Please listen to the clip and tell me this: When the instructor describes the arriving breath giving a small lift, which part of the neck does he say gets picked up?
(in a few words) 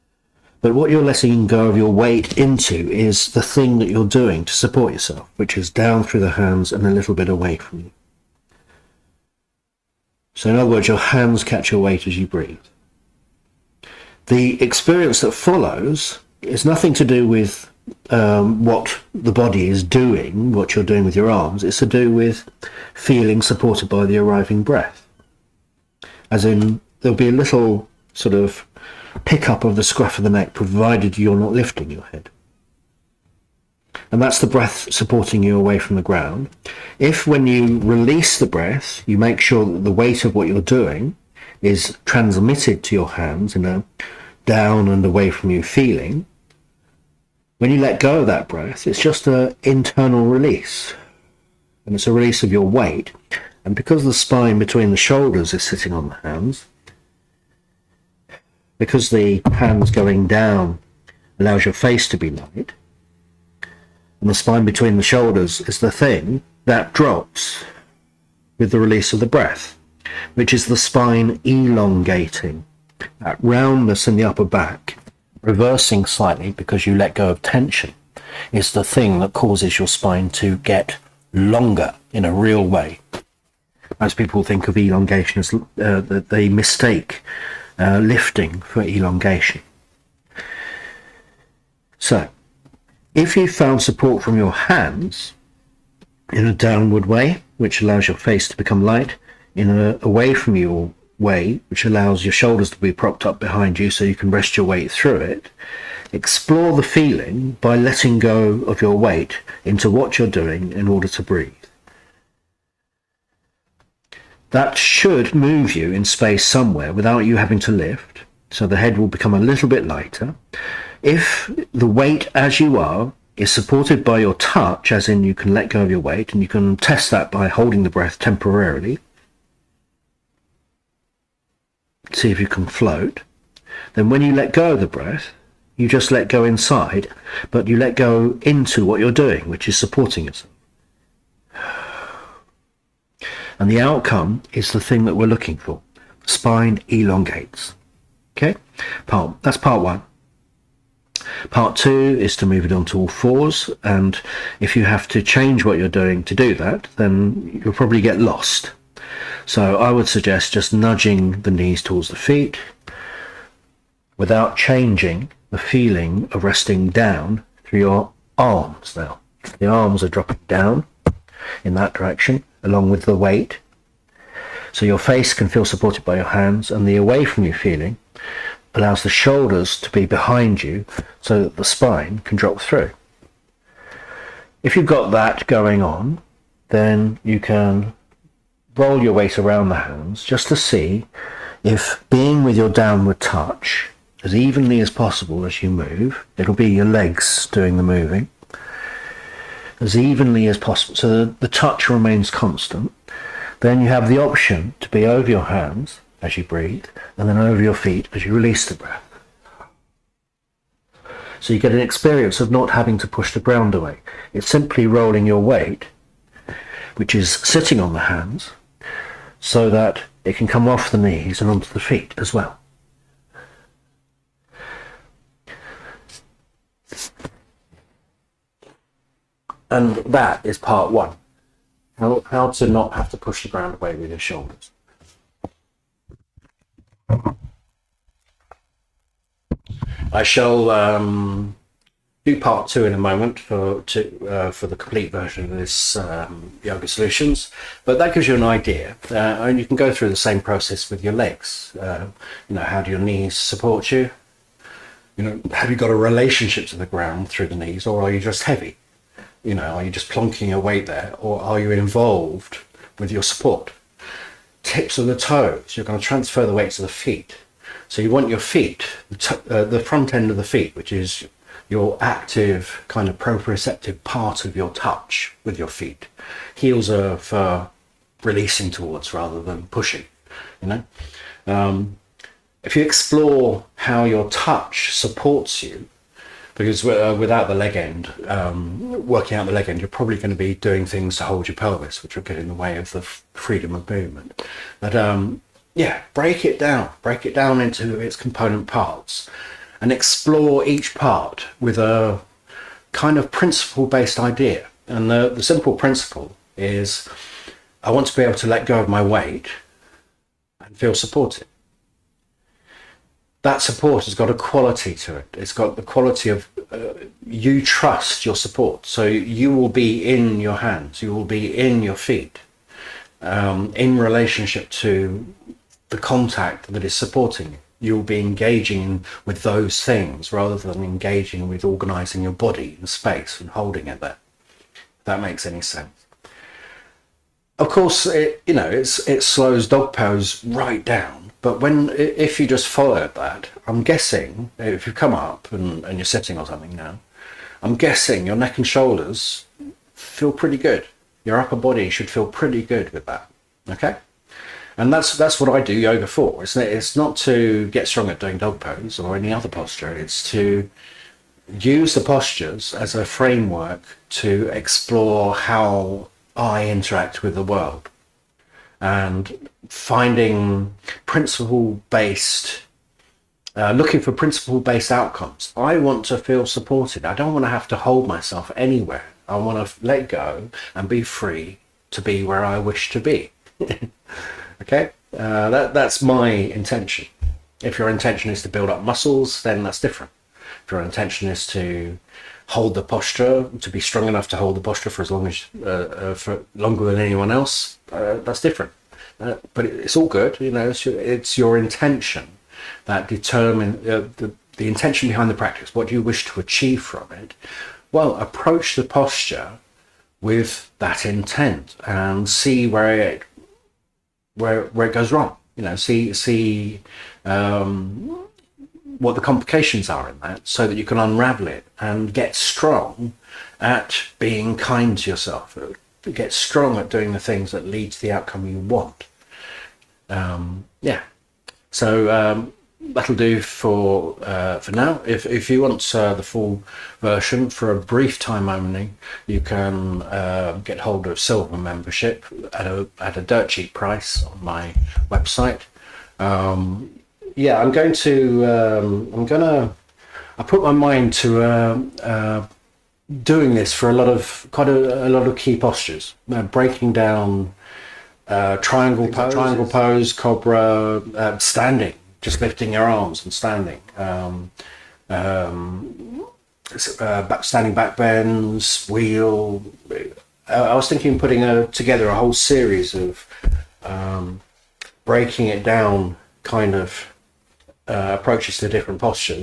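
The scruff of the neck.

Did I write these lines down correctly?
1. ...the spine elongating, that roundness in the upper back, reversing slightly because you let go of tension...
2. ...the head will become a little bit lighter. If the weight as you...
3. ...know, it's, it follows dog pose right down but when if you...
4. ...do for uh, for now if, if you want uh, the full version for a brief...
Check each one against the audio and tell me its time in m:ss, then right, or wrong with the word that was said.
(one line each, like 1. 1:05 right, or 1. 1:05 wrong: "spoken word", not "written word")
1. 1:10 right
2. 1:58 right
3. 5:38 wrong: "slows", not "follows"
4. 7:13 right.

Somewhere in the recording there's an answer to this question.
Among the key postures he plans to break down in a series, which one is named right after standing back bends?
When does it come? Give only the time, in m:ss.
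7:48.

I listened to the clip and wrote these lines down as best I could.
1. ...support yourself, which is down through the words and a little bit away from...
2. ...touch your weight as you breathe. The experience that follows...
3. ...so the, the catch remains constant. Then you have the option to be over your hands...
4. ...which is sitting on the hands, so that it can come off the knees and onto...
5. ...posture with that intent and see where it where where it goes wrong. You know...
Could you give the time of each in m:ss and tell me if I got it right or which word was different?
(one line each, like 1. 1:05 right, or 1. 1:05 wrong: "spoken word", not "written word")
1. 0:04 wrong: "hands", not "words"
2. 0:11 wrong: "catch", not "touch"
3. 3:20 wrong: "touch", not "catch"
4. 3:36 right
5. 6:48 right.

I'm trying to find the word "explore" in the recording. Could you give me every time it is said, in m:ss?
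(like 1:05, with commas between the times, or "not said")
1:46, 4:42, 4:59, 6:04.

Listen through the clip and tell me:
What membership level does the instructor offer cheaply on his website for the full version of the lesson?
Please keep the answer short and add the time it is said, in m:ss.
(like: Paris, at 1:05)
Silver membership, at 7:21.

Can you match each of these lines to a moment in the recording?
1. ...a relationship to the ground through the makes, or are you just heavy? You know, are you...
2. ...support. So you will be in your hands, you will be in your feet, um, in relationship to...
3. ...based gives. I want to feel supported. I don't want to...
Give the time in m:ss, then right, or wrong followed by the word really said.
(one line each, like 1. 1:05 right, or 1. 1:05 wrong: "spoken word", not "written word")
1. 4:15 wrong: "knees", not "makes"
2. 5:18 right
3. 6:14 wrong: "outcomes", not "gives".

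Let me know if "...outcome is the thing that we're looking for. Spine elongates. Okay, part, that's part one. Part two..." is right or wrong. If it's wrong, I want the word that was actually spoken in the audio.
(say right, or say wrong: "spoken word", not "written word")
right.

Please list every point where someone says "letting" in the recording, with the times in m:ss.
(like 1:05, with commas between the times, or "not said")
0:01, 1:47.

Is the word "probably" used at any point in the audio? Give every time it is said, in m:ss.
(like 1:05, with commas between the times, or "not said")
2:37, 4:49.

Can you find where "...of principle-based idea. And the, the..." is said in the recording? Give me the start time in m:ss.
5:03.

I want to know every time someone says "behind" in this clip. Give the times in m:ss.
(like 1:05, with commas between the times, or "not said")
1:43, 3:00, 6:45.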